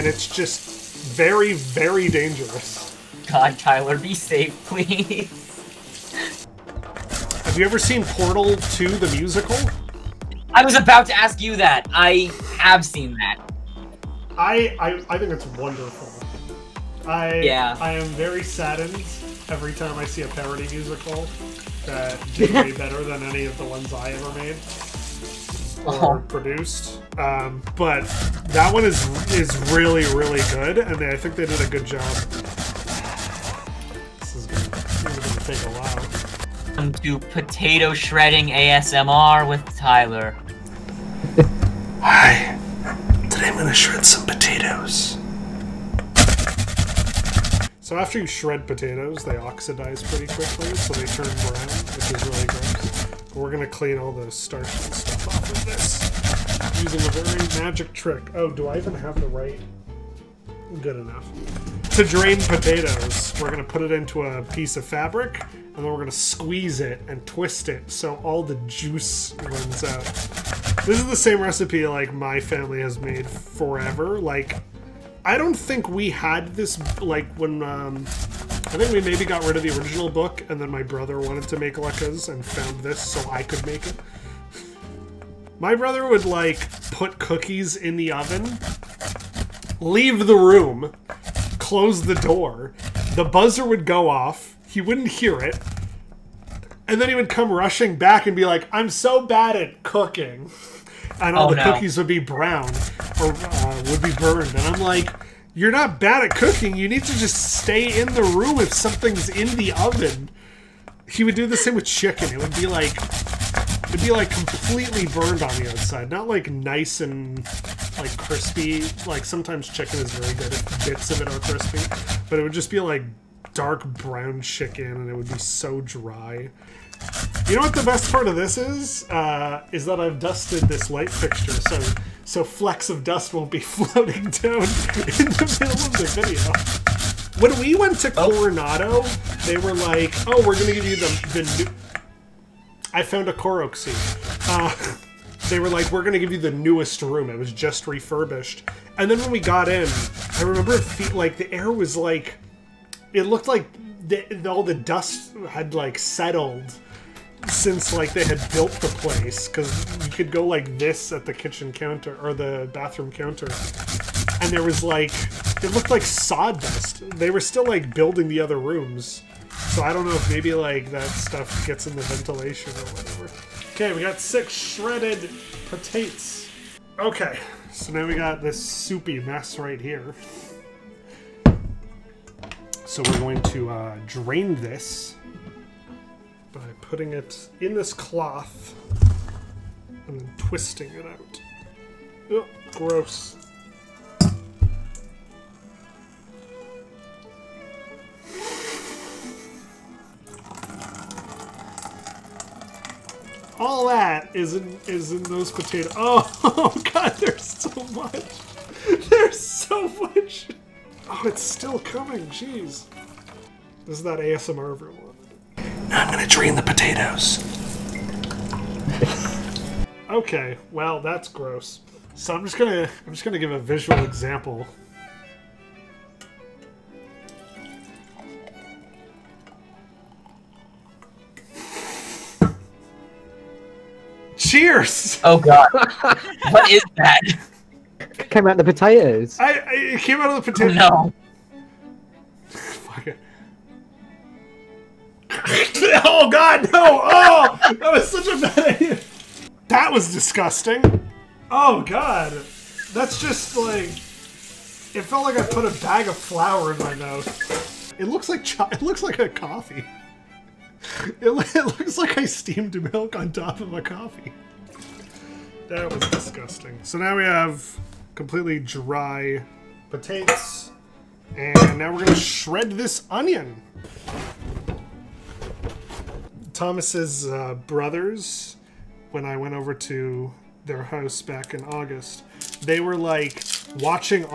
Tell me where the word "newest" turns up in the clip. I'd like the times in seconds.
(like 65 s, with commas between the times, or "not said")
146 s.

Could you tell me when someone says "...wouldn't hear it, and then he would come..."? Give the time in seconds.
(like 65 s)
94 s.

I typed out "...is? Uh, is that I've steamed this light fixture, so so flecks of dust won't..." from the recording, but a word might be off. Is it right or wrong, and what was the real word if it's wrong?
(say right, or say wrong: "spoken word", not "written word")
wrong: "dusted", not "steamed".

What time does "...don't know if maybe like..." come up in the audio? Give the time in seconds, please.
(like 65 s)
169 s.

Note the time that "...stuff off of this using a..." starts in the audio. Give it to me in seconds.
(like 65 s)
54 s.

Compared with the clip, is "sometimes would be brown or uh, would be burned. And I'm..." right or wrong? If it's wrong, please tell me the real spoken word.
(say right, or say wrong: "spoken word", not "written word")
wrong: "cookies", not "sometimes".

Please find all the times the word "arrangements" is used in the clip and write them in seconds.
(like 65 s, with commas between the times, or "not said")
not said.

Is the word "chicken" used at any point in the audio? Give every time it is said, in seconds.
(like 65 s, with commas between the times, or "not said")
111 s, 119 s, 124 s.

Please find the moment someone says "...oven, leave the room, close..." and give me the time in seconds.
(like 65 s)
88 s.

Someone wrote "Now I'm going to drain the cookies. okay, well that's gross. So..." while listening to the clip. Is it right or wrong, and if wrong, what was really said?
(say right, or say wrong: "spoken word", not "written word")
wrong: "potatoes", not "cookies".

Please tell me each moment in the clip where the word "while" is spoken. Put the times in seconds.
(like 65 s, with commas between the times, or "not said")
35 s.